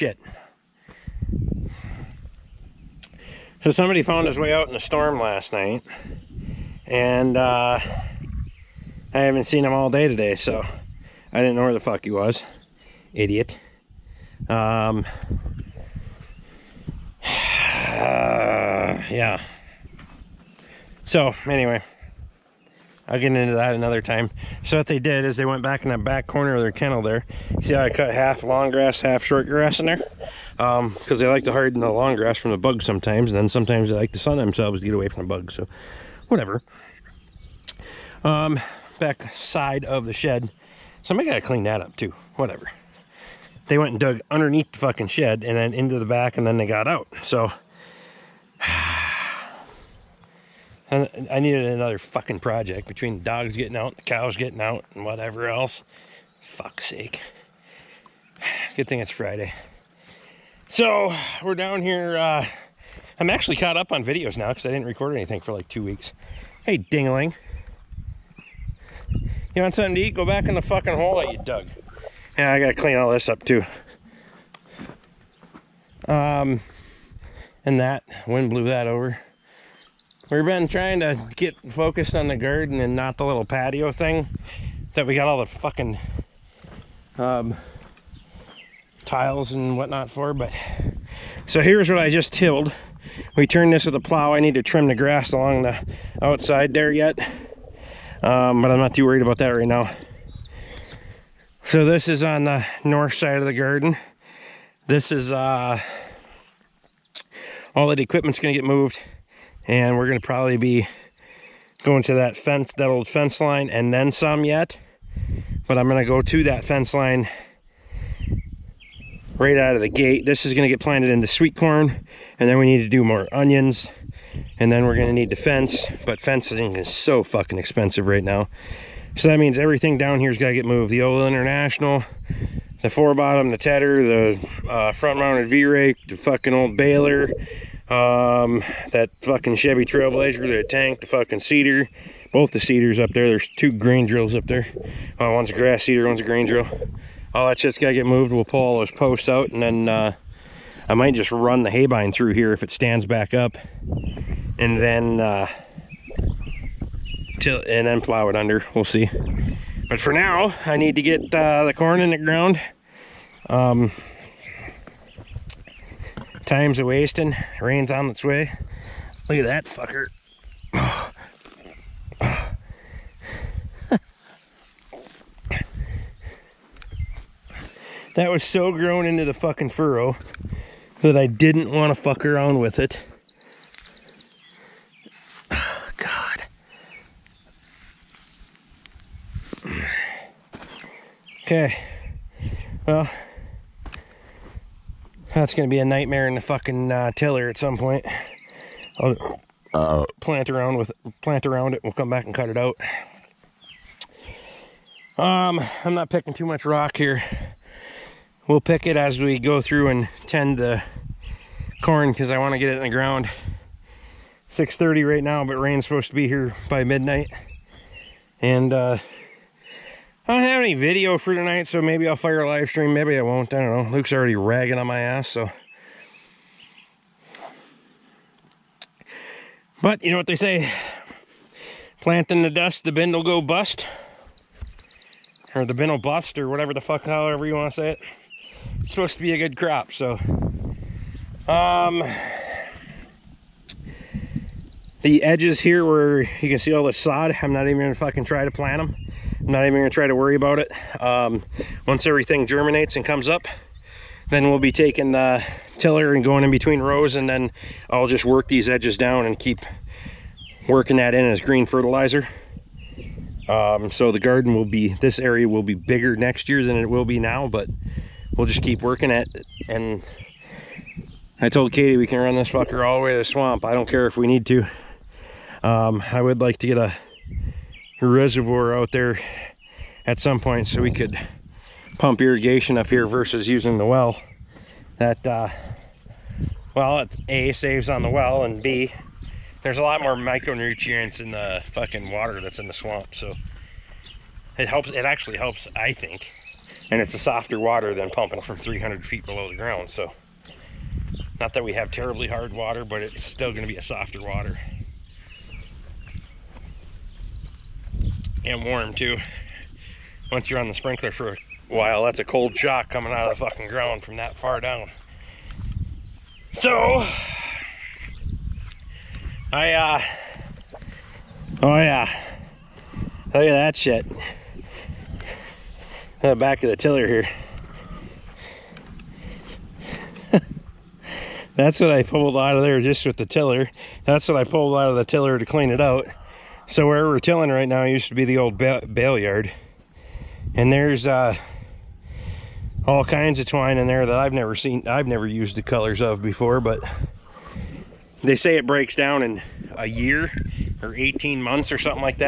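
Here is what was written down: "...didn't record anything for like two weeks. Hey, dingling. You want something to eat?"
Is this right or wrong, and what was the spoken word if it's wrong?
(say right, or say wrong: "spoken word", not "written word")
right.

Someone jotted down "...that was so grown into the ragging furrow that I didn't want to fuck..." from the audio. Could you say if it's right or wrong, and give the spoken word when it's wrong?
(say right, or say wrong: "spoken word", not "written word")
wrong: "fucking", not "ragging".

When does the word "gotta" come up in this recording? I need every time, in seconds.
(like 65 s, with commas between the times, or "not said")
72 s, 130 s, 147 s.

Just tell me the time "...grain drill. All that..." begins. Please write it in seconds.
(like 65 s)
146 s.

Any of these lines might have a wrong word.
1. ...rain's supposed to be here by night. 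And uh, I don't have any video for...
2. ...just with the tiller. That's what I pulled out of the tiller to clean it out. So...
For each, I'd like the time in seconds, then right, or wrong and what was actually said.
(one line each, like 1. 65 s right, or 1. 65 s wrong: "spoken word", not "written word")
1. 215 s wrong: "midnight", not "night"
2. 332 s right.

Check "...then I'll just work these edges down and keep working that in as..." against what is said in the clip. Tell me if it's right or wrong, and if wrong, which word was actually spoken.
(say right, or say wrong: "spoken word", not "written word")
right.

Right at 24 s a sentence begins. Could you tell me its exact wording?
So what they did is they went back in that back corner of their kennel there.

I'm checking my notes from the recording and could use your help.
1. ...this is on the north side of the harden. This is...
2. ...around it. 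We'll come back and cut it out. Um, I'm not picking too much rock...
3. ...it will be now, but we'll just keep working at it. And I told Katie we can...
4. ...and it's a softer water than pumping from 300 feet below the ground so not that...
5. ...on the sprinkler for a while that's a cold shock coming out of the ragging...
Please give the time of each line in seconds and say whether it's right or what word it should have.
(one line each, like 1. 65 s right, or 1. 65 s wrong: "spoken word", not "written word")
1. 101 s wrong: "garden", not "harden"
2. 201 s right
3. 266 s right
4. 296 s right
5. 310 s wrong: "fucking", not "ragging".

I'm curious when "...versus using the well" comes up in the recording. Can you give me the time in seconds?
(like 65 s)
283 s.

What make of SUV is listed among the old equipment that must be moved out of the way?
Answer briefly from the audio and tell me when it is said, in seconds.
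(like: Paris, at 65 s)
Chevy Trailblazer, at 139 s.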